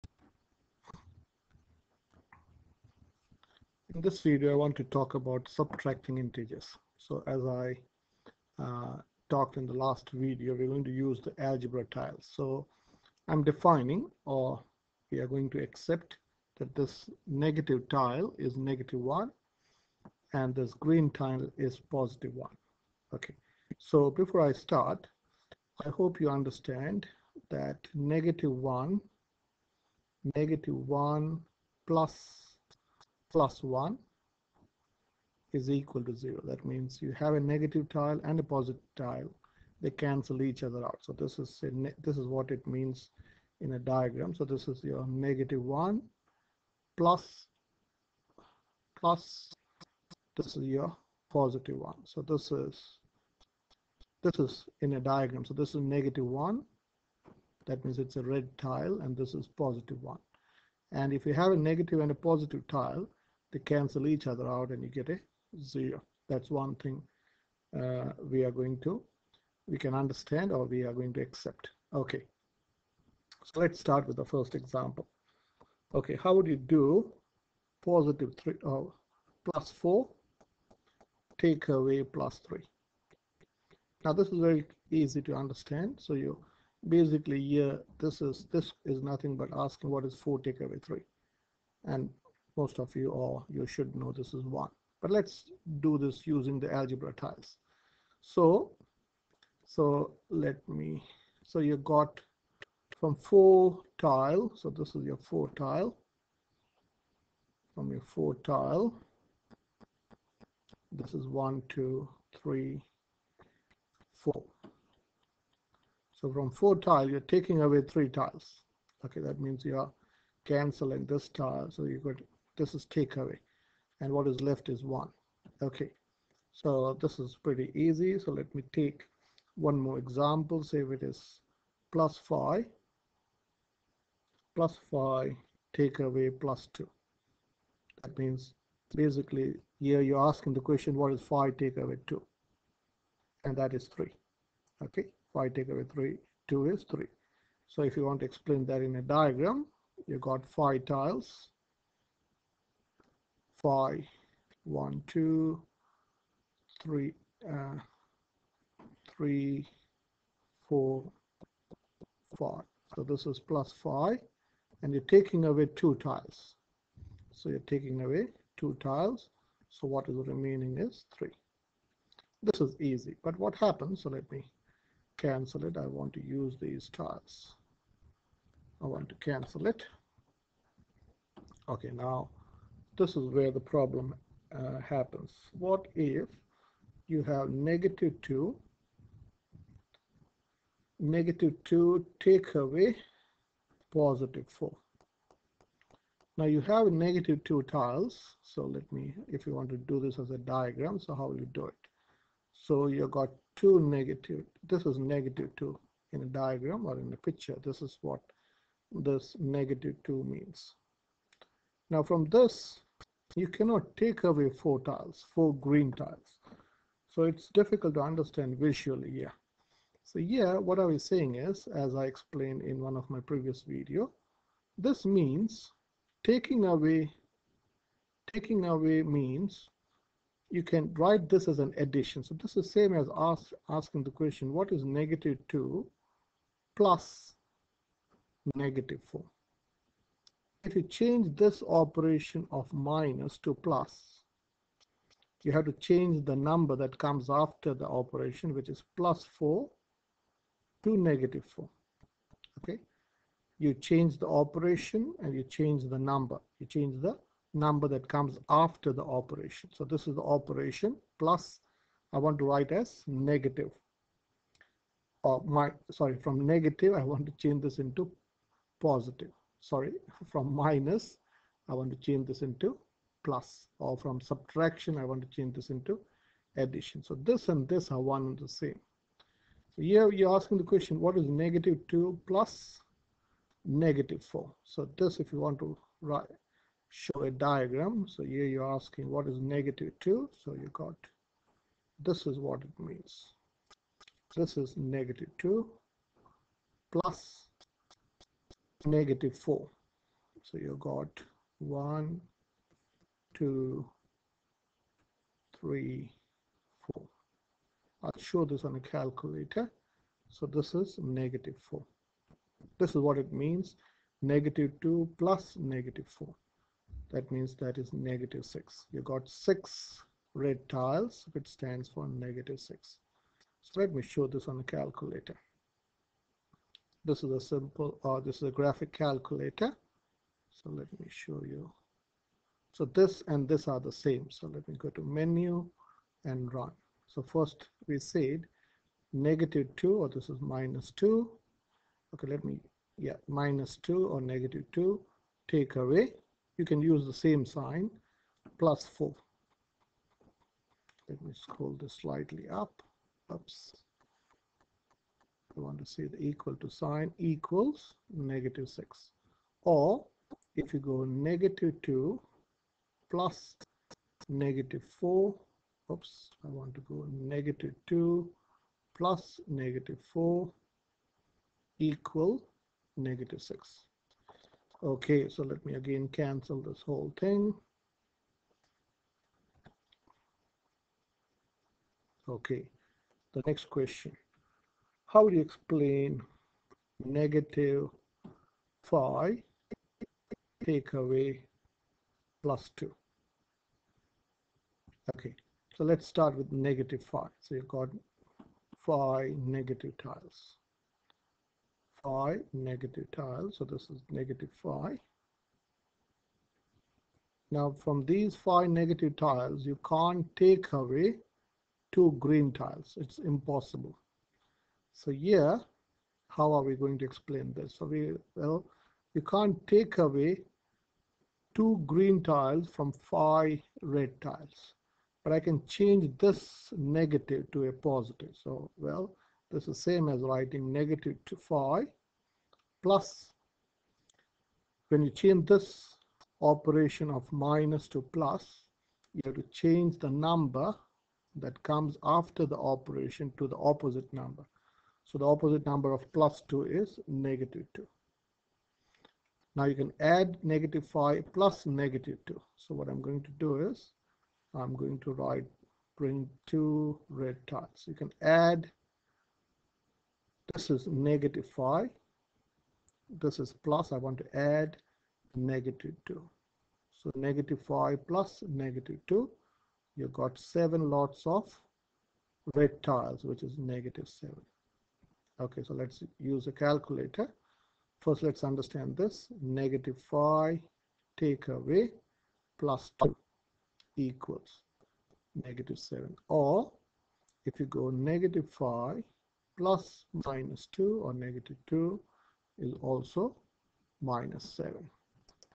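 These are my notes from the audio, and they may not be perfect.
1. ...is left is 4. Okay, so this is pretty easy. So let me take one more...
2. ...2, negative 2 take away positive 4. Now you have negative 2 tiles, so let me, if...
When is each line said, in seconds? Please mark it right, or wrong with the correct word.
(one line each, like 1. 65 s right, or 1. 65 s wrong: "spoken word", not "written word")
1. 124 s wrong: "1", not "4"
2. 188 s right.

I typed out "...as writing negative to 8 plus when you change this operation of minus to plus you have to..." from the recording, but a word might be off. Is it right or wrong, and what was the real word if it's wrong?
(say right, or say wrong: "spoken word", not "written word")
wrong: "5", not "8".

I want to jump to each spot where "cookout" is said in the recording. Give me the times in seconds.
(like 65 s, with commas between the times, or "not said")
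not said.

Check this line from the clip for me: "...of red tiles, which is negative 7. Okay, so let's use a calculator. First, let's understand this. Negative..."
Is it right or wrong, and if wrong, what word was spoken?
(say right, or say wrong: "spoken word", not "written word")
right.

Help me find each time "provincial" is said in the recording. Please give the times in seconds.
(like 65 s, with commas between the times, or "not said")
not said.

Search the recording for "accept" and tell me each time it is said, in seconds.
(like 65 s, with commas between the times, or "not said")
15 s, 71 s.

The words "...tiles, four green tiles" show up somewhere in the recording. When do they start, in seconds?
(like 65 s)
214 s.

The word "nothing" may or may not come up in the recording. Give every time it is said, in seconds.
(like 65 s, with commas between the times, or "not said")
89 s.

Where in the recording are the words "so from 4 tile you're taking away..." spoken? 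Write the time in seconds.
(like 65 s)
116 s.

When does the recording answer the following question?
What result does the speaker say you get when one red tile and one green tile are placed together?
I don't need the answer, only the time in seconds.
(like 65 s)
35 s.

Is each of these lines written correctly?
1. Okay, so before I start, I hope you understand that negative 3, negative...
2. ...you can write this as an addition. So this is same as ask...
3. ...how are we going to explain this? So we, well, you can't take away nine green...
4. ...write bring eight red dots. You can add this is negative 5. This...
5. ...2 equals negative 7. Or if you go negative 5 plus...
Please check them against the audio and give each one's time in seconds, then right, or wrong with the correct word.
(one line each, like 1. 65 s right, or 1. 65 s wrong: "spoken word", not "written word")
1. 23 s wrong: "1", not "3"
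2. 230 s right
3. 416 s wrong: "two", not "nine"
4. 455 s wrong: "two", not "eight"
5. 483 s right.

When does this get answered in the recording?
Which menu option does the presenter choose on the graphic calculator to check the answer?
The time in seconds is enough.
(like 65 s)
335 s.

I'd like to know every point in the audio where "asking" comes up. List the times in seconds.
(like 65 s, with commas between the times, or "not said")
89 s, 140 s, 233 s, 280 s, 288 s.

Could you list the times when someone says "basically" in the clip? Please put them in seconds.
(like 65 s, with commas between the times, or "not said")
86 s, 138 s.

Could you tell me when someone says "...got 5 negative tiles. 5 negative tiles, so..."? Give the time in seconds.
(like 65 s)
397 s.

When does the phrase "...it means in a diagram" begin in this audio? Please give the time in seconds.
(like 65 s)
42 s.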